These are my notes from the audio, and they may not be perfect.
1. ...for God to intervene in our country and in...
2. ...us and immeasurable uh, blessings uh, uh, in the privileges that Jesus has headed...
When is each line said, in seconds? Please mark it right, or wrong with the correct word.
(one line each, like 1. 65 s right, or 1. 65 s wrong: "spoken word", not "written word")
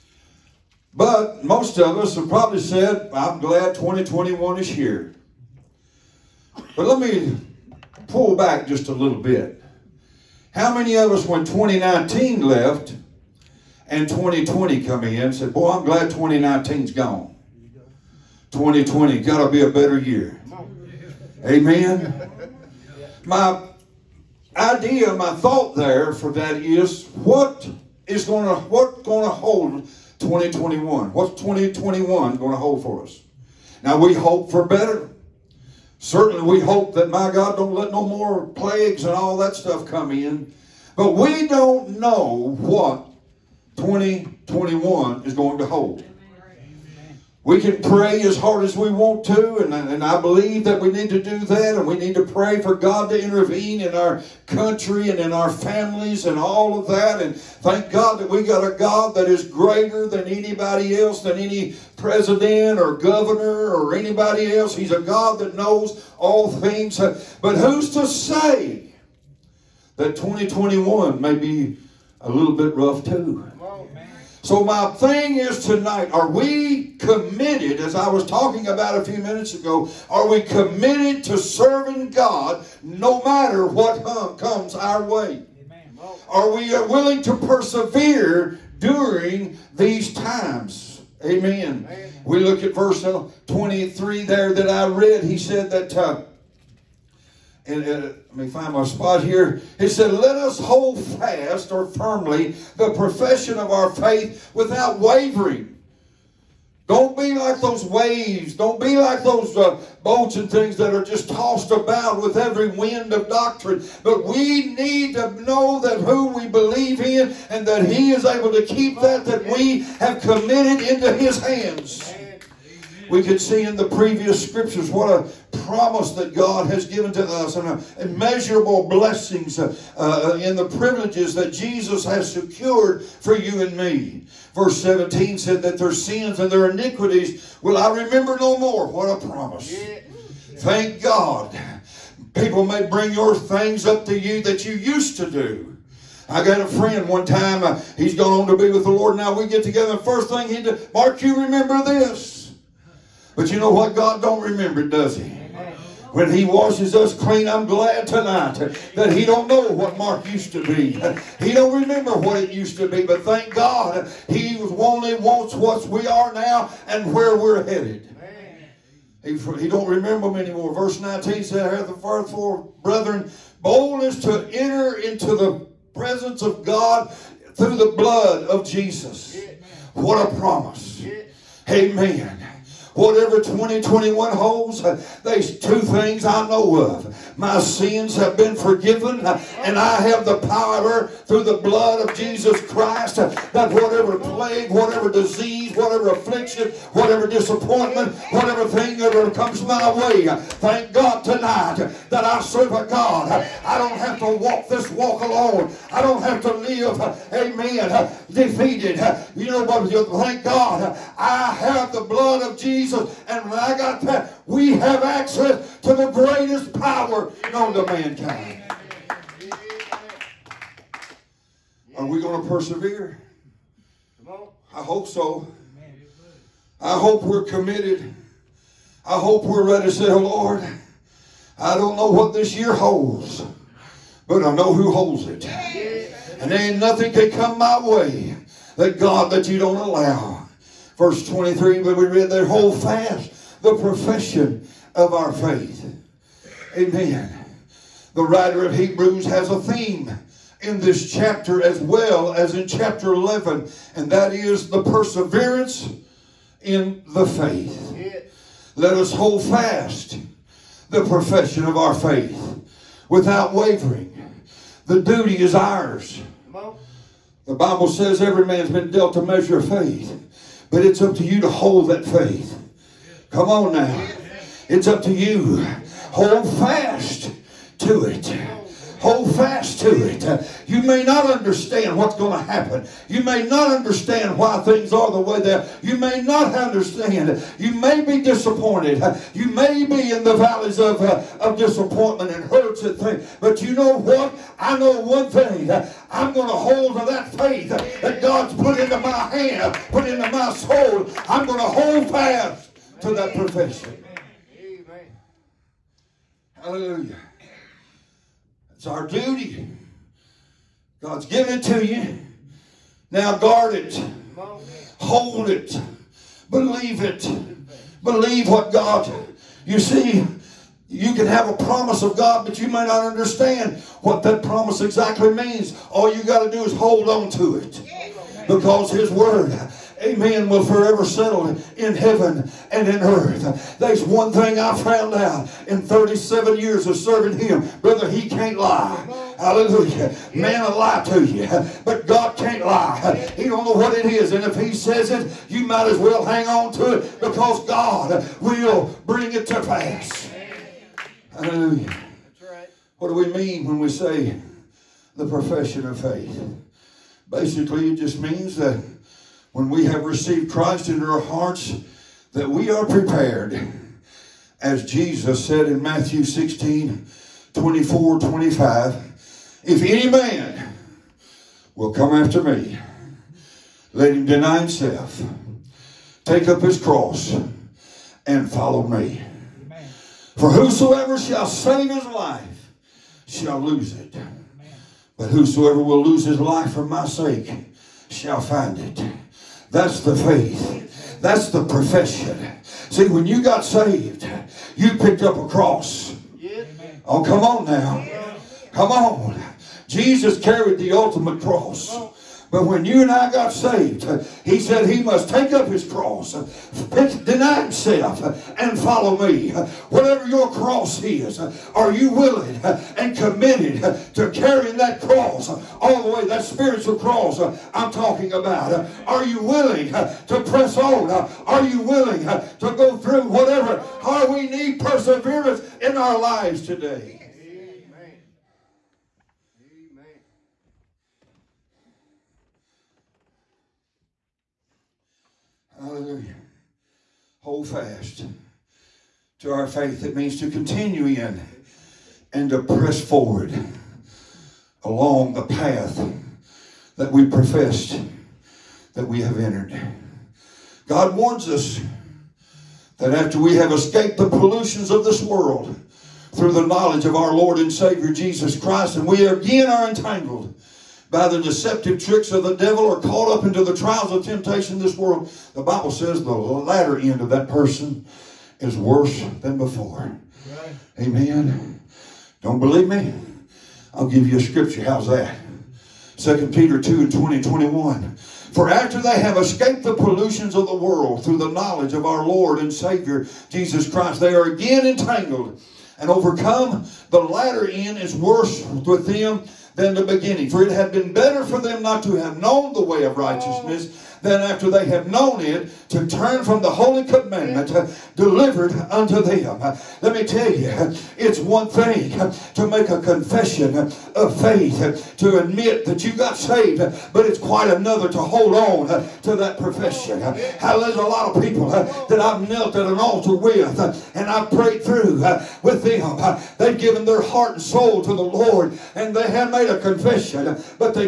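1. 52 s right
2. 127 s wrong: "secured", not "headed".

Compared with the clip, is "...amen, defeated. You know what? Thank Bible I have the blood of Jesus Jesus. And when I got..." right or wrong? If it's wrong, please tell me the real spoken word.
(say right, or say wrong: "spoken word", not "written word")
wrong: "God", not "Bible".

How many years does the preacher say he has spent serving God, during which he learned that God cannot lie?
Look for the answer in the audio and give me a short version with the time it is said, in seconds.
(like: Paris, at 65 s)
37, at 335 s.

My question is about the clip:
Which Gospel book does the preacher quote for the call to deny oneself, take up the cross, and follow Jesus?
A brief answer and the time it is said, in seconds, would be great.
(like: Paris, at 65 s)
Matthew, at 365 s.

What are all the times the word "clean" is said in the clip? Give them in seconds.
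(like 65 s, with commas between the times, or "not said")
157 s.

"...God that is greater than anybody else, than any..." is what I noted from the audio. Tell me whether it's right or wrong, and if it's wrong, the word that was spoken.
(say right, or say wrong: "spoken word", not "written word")
right.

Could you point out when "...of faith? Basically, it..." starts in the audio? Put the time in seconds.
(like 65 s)
355 s.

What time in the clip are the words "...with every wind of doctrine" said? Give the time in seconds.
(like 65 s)
112 s.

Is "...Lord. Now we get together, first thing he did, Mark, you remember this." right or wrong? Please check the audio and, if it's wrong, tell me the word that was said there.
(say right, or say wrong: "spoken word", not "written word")
right.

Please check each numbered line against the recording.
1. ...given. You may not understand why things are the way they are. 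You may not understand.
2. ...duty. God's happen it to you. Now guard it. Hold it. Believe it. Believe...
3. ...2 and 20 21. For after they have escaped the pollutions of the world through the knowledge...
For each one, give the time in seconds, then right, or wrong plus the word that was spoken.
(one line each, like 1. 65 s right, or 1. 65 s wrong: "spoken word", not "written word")
1. 282 s wrong: "happen", not "given"
2. 309 s wrong: "given", not "happen"
3. 476 s right.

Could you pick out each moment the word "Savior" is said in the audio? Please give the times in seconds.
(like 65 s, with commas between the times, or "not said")
457 s, 482 s.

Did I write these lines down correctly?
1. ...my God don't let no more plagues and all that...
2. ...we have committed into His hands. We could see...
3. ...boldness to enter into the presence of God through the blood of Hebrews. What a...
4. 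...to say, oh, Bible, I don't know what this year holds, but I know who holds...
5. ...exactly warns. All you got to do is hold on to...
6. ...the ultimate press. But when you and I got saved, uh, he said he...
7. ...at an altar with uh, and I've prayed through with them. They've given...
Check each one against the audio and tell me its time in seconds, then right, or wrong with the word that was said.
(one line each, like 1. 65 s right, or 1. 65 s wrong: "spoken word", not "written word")
1. 37 s right
2. 119 s right
3. 173 s wrong: "Jesus", not "Hebrews"
4. 229 s wrong: "Lord", not "Bible"
5. 324 s wrong: "means", not "warns"
6. 400 s wrong: "cross", not "press"
7. 512 s right.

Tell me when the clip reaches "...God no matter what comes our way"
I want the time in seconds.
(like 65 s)
82 s.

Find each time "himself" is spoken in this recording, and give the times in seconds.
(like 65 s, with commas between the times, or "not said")
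374 s, 407 s.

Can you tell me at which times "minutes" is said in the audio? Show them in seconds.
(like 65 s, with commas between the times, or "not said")
79 s.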